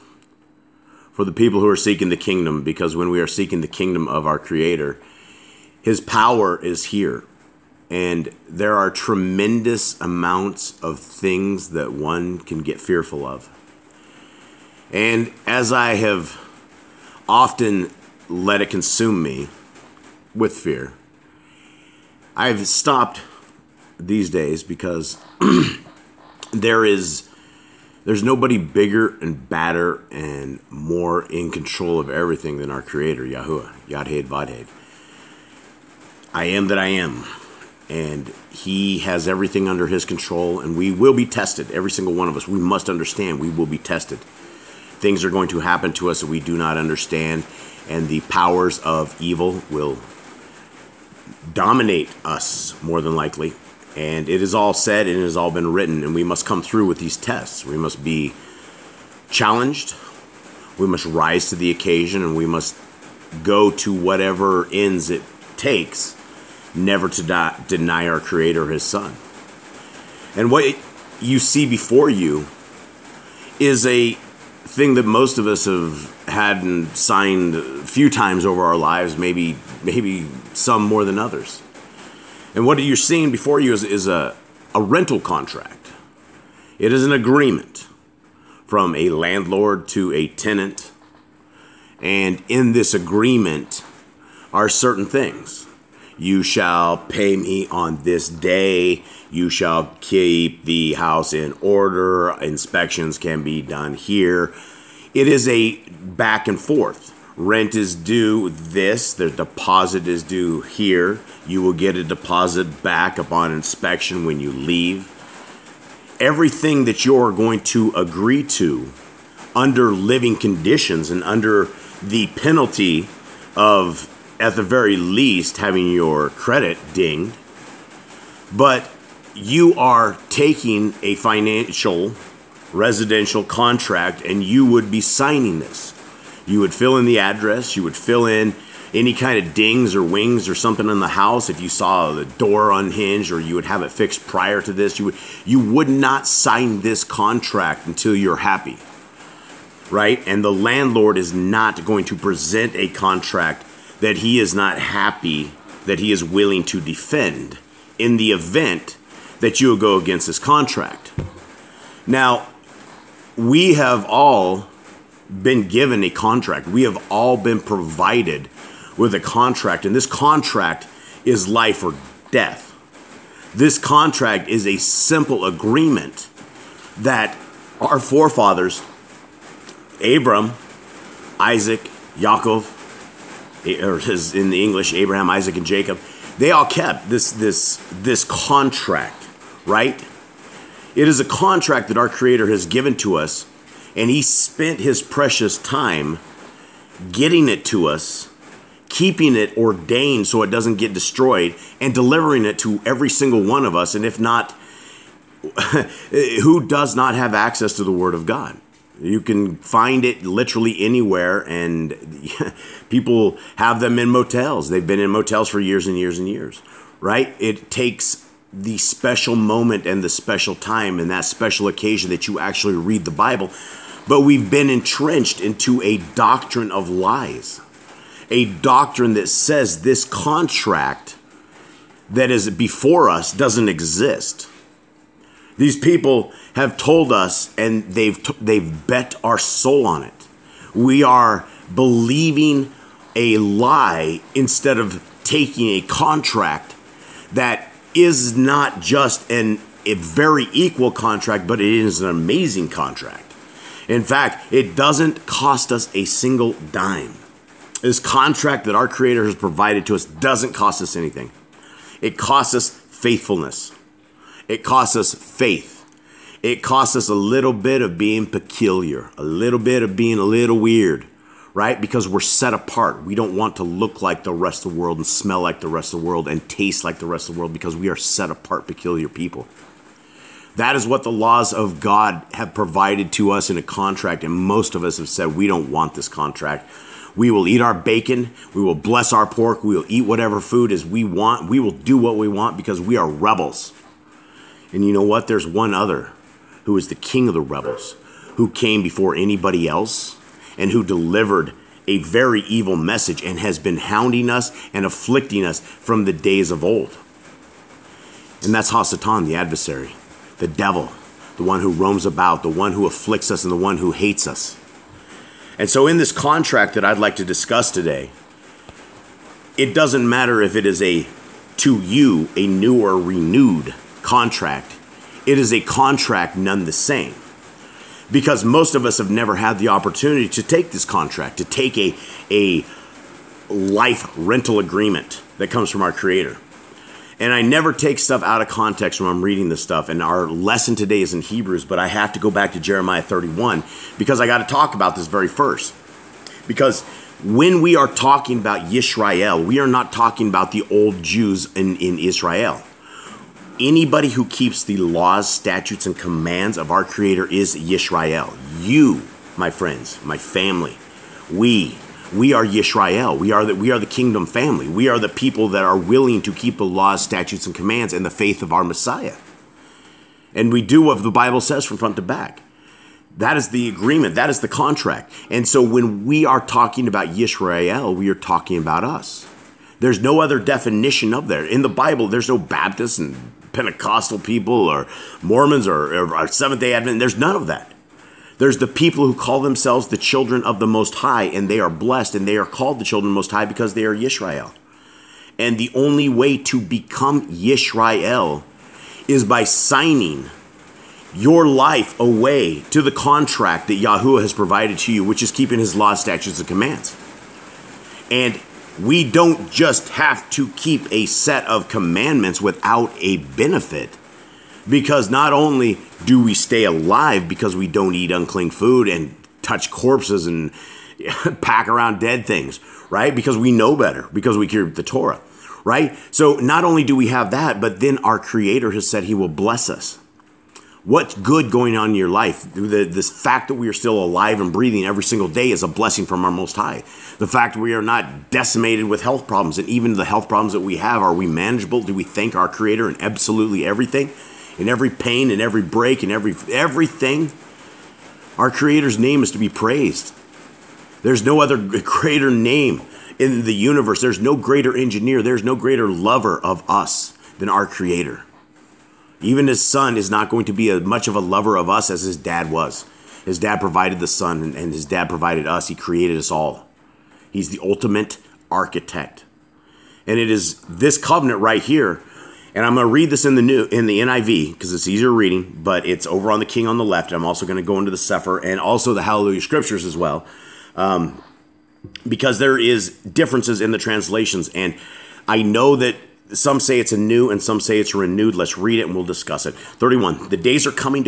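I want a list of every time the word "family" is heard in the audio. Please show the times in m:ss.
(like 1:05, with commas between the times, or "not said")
6:00, 6:04.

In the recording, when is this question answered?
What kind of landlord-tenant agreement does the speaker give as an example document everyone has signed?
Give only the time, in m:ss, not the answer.
1:24.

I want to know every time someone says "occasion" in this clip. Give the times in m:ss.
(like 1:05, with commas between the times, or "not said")
1:01, 3:41.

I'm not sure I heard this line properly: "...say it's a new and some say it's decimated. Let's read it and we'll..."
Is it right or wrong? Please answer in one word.
wrong.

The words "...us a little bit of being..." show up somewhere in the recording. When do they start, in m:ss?
4:26.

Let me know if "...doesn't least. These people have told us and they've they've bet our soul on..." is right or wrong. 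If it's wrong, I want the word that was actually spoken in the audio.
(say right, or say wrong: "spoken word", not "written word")
wrong: "exist", not "least".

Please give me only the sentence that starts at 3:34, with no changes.
They've been in motels for years and years and years, right?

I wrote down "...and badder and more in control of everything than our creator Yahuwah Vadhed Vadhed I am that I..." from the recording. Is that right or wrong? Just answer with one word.
wrong.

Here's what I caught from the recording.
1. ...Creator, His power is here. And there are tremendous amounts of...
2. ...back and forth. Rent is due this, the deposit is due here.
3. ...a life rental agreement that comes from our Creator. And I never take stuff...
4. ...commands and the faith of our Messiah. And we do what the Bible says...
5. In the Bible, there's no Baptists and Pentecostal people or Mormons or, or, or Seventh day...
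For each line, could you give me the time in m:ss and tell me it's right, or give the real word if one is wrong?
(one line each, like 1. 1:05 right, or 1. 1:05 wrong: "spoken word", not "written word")
1. 0:04 right
2. 1:45 right
3. 5:32 right
4. 6:07 right
5. 6:21 right.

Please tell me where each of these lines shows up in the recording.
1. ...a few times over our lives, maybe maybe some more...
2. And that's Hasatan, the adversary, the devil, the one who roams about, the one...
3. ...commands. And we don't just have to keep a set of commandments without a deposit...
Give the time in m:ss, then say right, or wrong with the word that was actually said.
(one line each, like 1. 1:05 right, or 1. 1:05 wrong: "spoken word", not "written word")
1. 1:17 right
2. 5:08 right
3. 6:46 wrong: "benefit", not "deposit".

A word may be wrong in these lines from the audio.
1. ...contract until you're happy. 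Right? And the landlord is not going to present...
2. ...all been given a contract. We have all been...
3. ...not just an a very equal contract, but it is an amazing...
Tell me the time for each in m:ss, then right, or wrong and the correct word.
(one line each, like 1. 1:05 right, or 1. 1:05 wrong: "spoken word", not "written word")
1. 2:27 right
2. 2:44 right
3. 4:08 right.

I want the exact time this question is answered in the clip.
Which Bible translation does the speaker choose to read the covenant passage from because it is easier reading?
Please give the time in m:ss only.
7:53.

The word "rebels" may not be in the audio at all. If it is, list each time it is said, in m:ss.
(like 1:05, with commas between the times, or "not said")
4:53, 4:57.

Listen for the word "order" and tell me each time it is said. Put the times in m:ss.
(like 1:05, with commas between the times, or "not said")
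1:41.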